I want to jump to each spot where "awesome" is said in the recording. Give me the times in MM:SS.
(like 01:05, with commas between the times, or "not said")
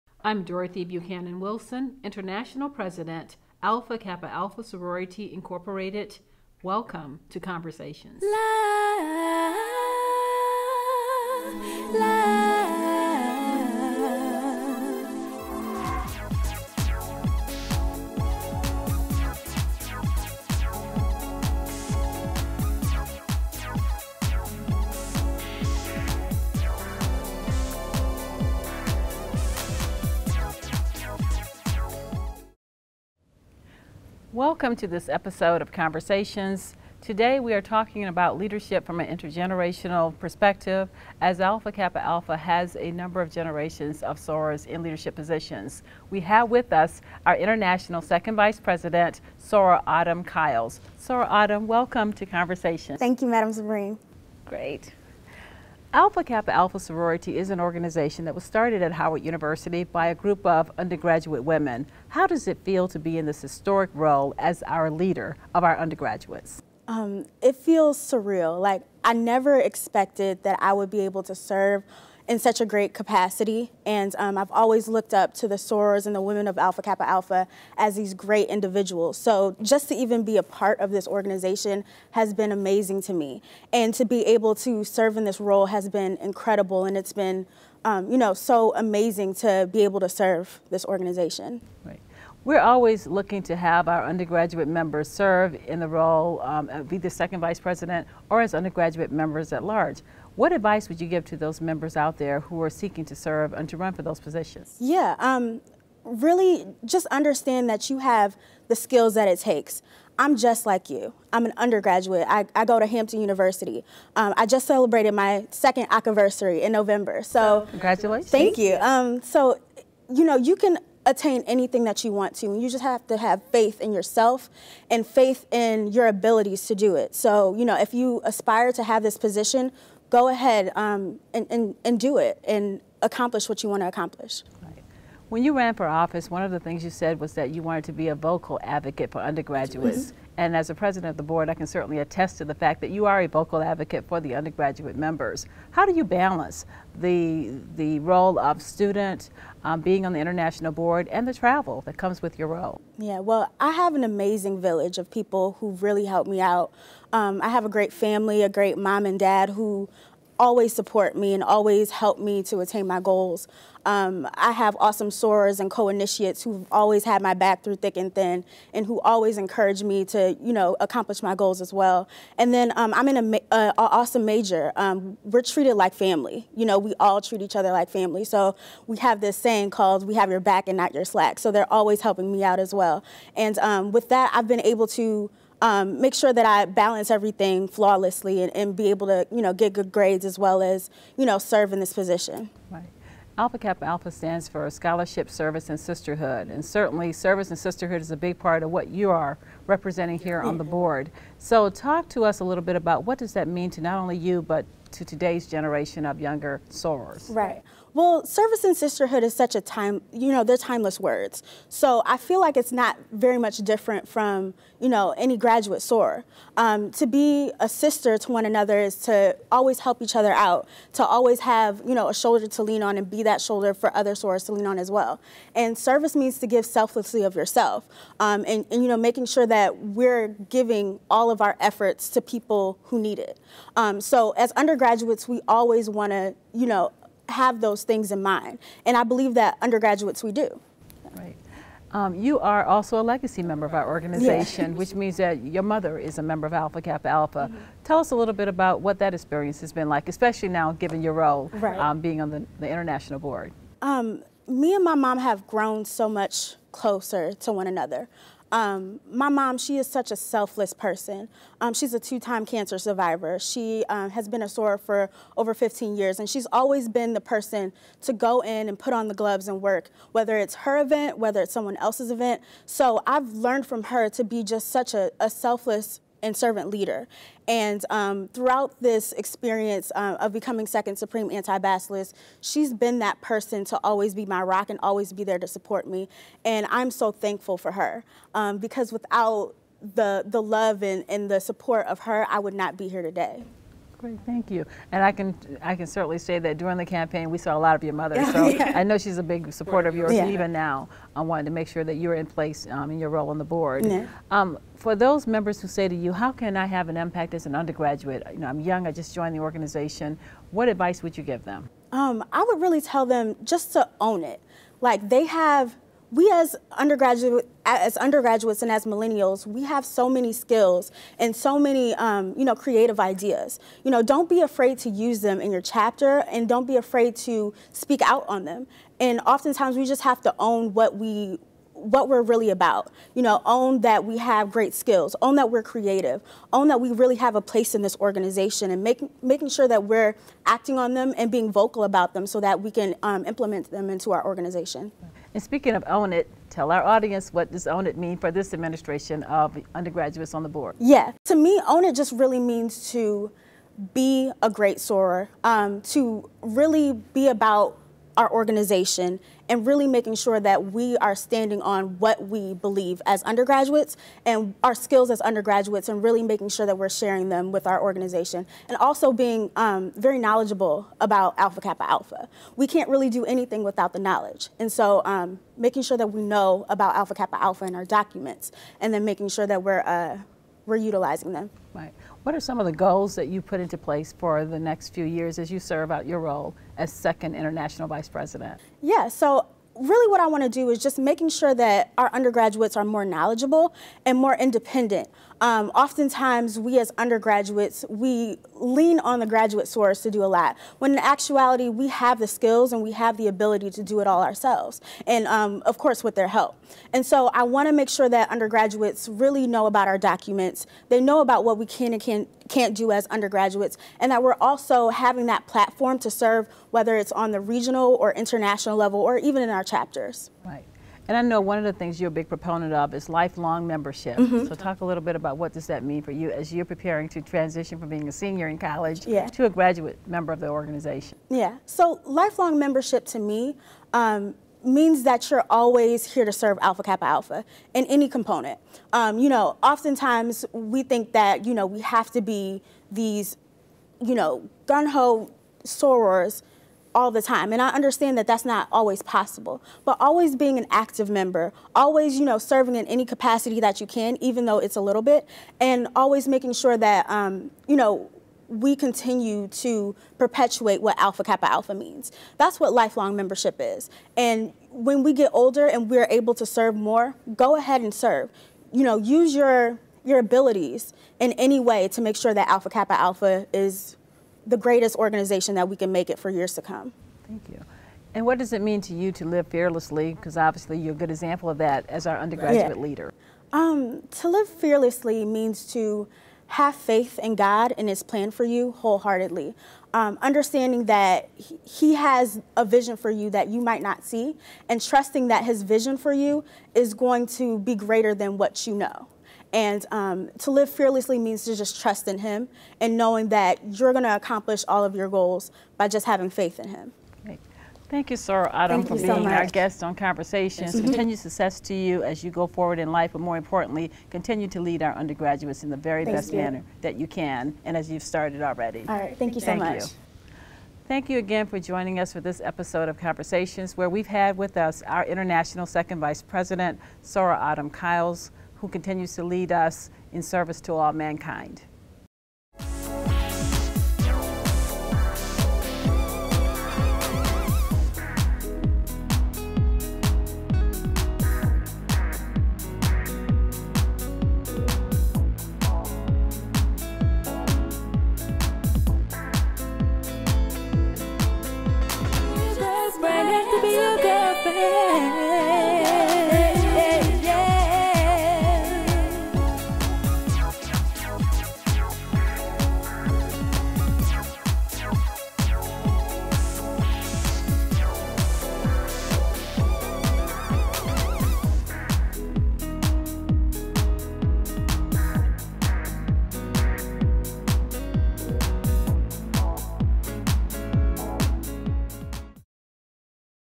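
02:44, 02:53.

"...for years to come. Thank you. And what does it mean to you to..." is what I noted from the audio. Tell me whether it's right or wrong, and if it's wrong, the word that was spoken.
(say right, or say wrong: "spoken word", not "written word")
right.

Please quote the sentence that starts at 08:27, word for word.
Thank you, Soror Autumn, Thank for being so our guest on Conversations.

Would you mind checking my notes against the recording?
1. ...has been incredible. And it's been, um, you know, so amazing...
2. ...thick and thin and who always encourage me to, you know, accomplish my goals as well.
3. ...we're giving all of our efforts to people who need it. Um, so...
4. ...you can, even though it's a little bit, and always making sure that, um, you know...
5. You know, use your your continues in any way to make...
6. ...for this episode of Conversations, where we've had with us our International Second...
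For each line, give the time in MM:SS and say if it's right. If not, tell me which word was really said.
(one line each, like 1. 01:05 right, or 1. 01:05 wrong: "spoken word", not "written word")
1. 01:25 right
2. 02:47 right
3. 03:49 right
4. 07:33 right
5. 07:48 wrong: "abilities", not "continues"
6. 08:42 right.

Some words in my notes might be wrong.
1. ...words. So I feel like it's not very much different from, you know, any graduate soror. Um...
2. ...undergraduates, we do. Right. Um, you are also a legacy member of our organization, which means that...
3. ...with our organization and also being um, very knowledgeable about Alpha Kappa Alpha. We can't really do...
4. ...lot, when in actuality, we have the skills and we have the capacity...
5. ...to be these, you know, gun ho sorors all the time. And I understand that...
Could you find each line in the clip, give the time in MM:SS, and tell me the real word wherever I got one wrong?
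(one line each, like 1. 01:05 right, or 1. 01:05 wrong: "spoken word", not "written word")
1. 03:30 right
2. 03:59 right
3. 06:07 right
4. 06:40 wrong: "ability", not "capacity"
5. 07:22 right.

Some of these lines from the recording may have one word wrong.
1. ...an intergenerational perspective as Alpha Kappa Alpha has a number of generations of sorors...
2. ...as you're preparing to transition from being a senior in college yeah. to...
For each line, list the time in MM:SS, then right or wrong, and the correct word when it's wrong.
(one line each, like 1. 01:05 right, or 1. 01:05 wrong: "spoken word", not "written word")
1. 00:38 right
2. 07:06 right.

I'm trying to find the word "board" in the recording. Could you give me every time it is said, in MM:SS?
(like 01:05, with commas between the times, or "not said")
02:21, 02:30, 03:20, 04:13, 05:03, 05:50.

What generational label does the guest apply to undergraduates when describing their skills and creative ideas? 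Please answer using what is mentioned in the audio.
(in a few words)
millennials.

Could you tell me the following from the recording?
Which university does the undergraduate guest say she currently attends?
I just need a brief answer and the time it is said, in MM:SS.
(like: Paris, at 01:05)
Hampton University, at 01:52.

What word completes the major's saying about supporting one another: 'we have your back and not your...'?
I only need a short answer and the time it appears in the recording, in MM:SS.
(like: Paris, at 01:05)
slack, at 03:01.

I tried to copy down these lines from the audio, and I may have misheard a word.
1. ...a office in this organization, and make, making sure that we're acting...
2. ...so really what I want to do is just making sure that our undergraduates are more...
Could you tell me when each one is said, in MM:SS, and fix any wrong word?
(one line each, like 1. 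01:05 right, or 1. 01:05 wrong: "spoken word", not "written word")
1. 05:37 wrong: "place", not "office"
2. 06:29 right.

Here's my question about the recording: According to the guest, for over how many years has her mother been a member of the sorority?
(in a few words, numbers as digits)
15.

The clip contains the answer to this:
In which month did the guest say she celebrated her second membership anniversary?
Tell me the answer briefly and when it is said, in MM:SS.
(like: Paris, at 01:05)
November, at 01:56.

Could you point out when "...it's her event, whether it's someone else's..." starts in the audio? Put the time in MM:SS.
04:30.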